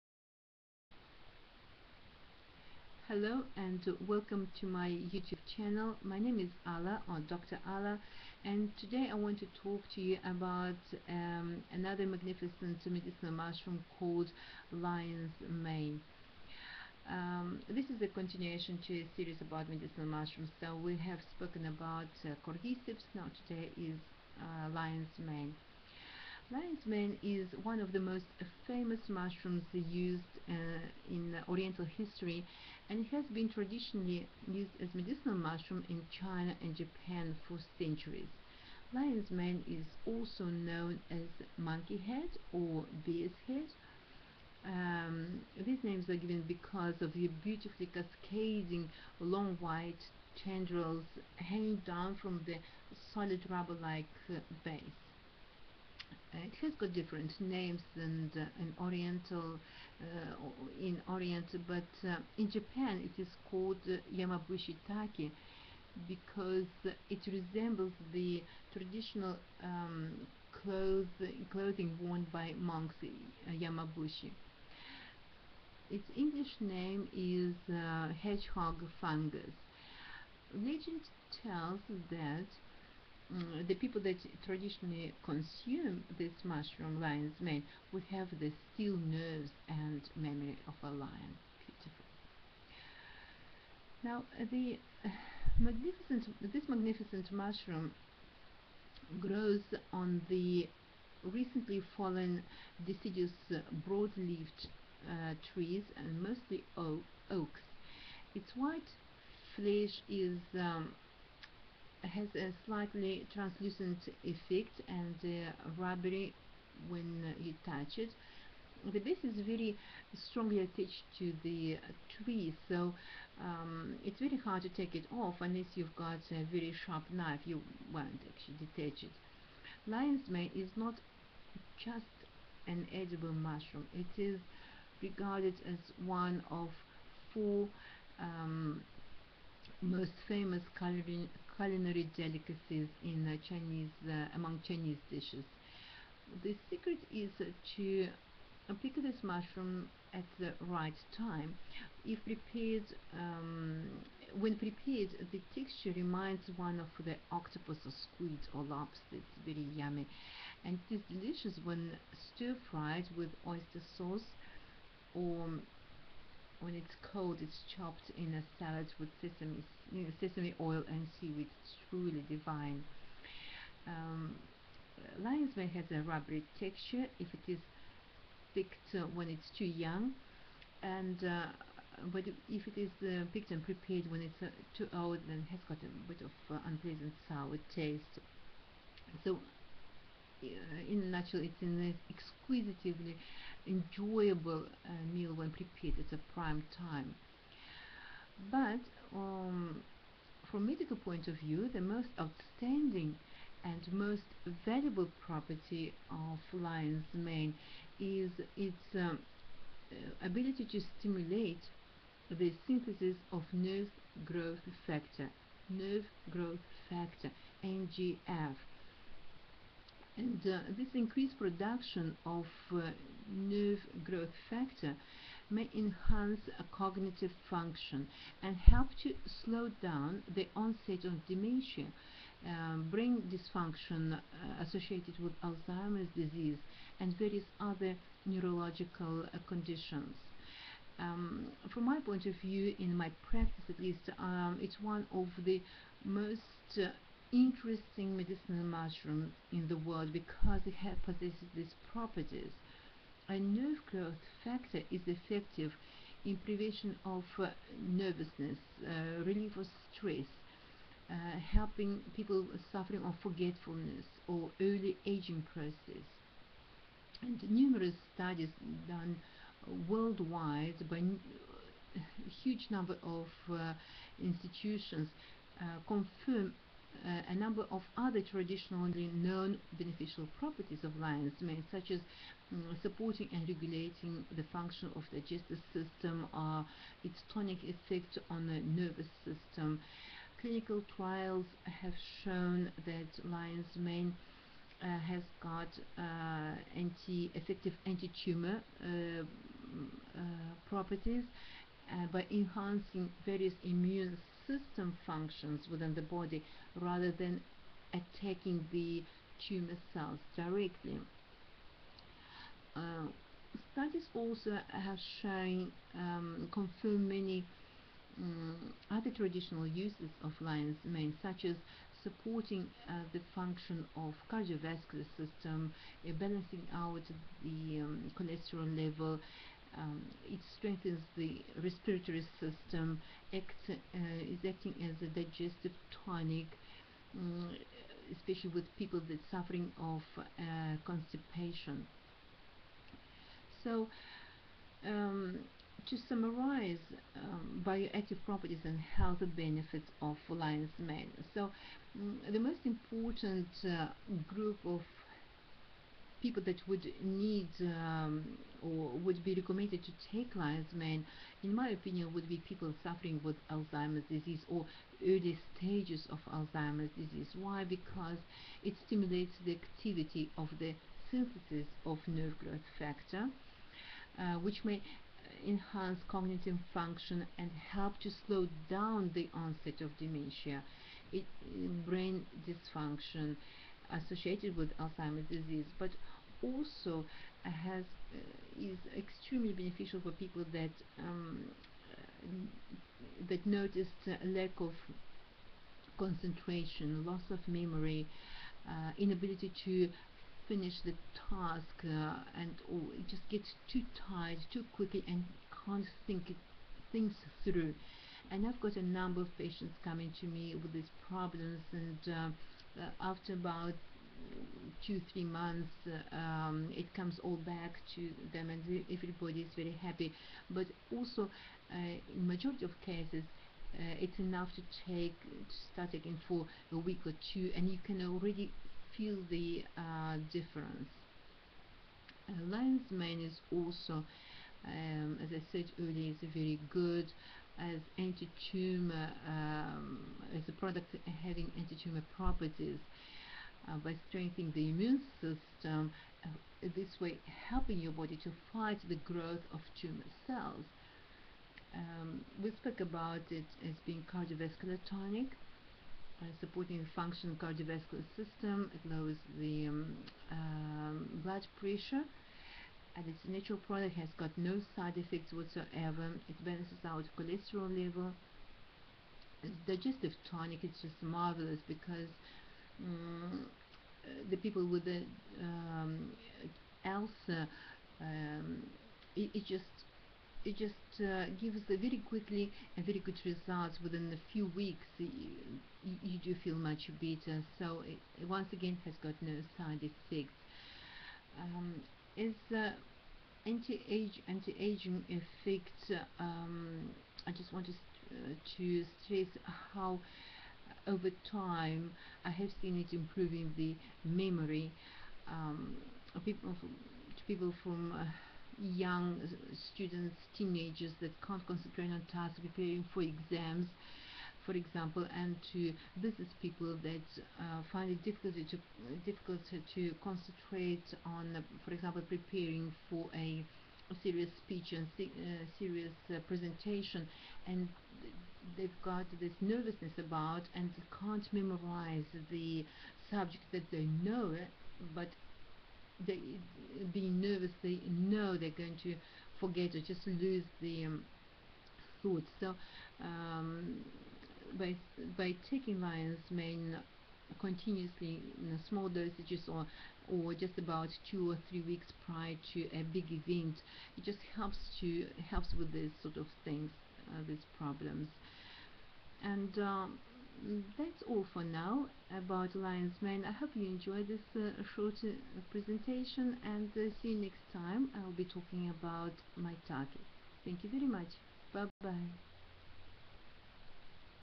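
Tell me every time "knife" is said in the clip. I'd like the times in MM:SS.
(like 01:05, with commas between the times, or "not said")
02:07.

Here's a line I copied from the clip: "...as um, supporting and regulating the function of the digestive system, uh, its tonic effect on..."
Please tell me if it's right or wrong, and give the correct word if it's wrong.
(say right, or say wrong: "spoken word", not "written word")
right.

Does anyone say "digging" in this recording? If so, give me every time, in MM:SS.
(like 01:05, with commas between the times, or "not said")
not said.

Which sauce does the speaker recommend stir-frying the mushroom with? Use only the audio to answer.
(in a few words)
Oyster sauce.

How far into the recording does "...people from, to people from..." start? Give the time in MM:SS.
08:26.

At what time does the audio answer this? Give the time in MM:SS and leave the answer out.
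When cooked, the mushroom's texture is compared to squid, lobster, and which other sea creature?
02:37.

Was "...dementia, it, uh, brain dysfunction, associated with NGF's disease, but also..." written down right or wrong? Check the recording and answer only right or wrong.
wrong.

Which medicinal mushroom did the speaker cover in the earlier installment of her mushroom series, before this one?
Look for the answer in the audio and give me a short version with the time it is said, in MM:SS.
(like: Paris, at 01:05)
Cordyceps, at 00:22.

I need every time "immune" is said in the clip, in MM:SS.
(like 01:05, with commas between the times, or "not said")
05:03, 07:24.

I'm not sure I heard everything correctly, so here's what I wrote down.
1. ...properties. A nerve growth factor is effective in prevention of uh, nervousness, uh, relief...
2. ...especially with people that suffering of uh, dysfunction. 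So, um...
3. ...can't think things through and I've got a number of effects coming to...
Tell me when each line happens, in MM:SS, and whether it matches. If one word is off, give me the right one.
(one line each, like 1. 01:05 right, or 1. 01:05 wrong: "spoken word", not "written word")
1. 04:11 right
2. 05:38 wrong: "constipation", not "dysfunction"
3. 06:45 wrong: "patients", not "effects".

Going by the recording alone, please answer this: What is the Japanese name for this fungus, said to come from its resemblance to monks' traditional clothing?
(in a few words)
Yamabushi Taki.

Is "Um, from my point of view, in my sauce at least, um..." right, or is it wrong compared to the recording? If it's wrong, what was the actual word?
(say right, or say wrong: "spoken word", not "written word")
wrong: "practice", not "sauce".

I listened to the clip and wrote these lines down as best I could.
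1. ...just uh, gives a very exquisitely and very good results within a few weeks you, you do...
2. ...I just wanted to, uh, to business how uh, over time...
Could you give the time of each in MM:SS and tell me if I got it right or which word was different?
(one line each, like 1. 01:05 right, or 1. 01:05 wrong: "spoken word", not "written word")
1. 08:00 wrong: "quickly", not "exquisitely"
2. 08:17 wrong: "stress", not "business".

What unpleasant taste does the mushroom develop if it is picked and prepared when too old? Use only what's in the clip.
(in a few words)
Sour.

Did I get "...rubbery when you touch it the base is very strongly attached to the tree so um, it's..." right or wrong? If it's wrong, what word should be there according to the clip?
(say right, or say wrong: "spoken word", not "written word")
right.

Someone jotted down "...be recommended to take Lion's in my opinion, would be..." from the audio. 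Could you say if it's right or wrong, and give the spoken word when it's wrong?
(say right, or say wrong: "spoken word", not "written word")
right.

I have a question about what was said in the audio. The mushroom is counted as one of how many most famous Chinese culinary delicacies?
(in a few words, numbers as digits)
4.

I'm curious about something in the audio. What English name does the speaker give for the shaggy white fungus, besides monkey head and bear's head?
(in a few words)
Hedgehog fungus.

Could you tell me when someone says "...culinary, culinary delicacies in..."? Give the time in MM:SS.
02:20.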